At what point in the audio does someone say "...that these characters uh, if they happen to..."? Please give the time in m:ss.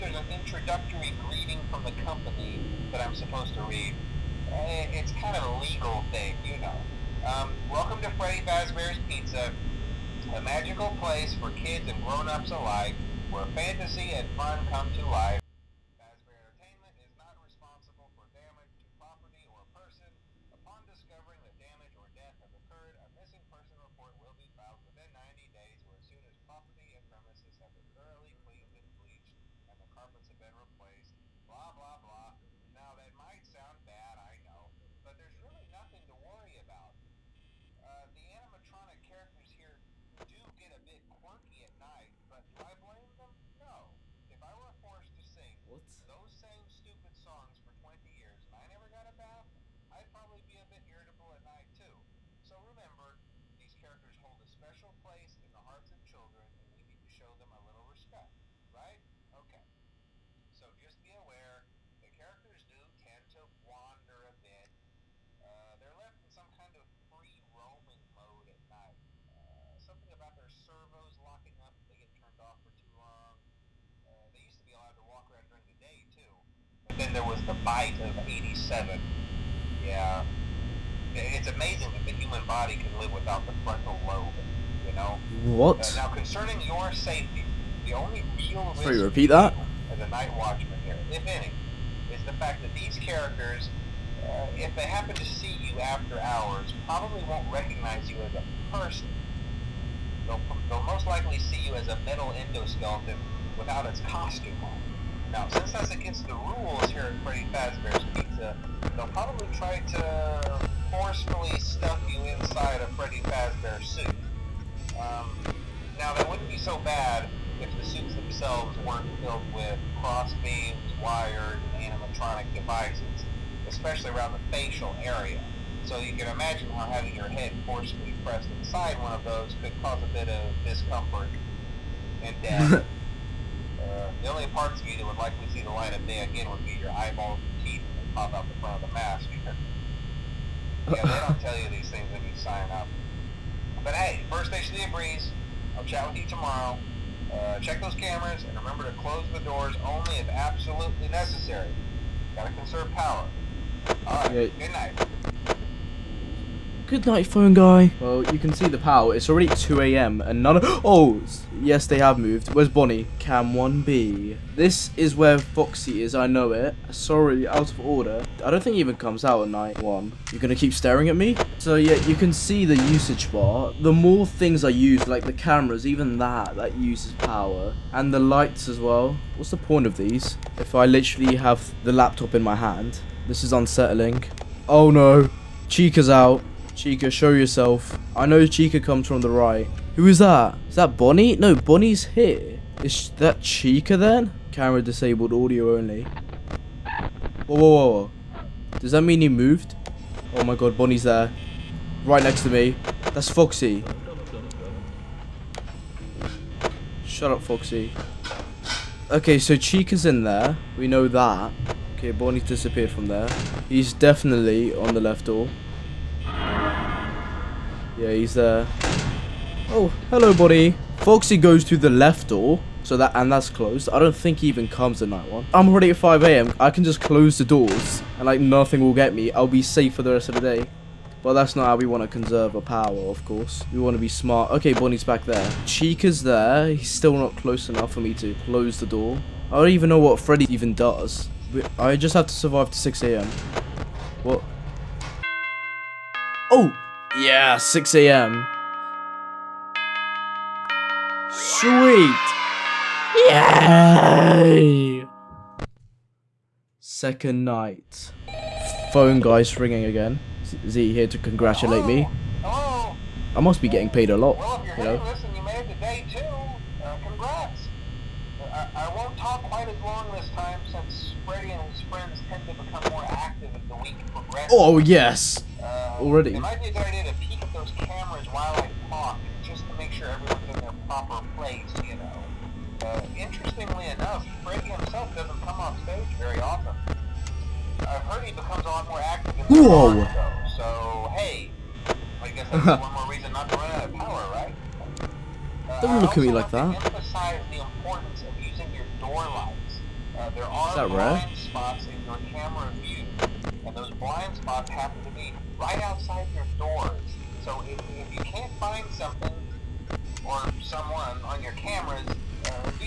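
1:32.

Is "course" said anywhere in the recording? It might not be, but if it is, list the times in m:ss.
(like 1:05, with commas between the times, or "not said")
3:53.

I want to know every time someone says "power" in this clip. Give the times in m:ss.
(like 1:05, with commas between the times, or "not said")
2:32, 2:38, 2:57, 3:52, 4:53.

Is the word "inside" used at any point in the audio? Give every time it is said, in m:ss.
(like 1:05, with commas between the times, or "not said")
1:52, 2:08.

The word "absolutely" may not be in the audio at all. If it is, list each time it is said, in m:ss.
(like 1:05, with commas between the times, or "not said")
2:30.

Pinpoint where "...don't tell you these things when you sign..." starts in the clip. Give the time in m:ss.
2:21.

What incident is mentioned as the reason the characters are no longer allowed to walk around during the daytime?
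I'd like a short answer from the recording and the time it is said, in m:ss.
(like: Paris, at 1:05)
The bite of 87, at 1:17.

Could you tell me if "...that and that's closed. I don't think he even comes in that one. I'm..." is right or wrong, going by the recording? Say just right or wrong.
right.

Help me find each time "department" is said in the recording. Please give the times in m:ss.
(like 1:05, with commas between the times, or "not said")
not said.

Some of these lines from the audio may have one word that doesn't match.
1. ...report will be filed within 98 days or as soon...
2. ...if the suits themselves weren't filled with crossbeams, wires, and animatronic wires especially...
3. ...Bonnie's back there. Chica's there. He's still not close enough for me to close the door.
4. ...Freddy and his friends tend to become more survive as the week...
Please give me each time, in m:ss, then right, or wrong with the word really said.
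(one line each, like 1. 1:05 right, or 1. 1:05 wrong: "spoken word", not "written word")
1. 0:23 wrong: "90", not "98"
2. 1:57 wrong: "devices", not "wires"
3. 3:54 right
4. 4:31 wrong: "active", not "survive".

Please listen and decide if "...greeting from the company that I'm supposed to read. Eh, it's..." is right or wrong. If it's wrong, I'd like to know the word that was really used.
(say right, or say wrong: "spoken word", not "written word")
right.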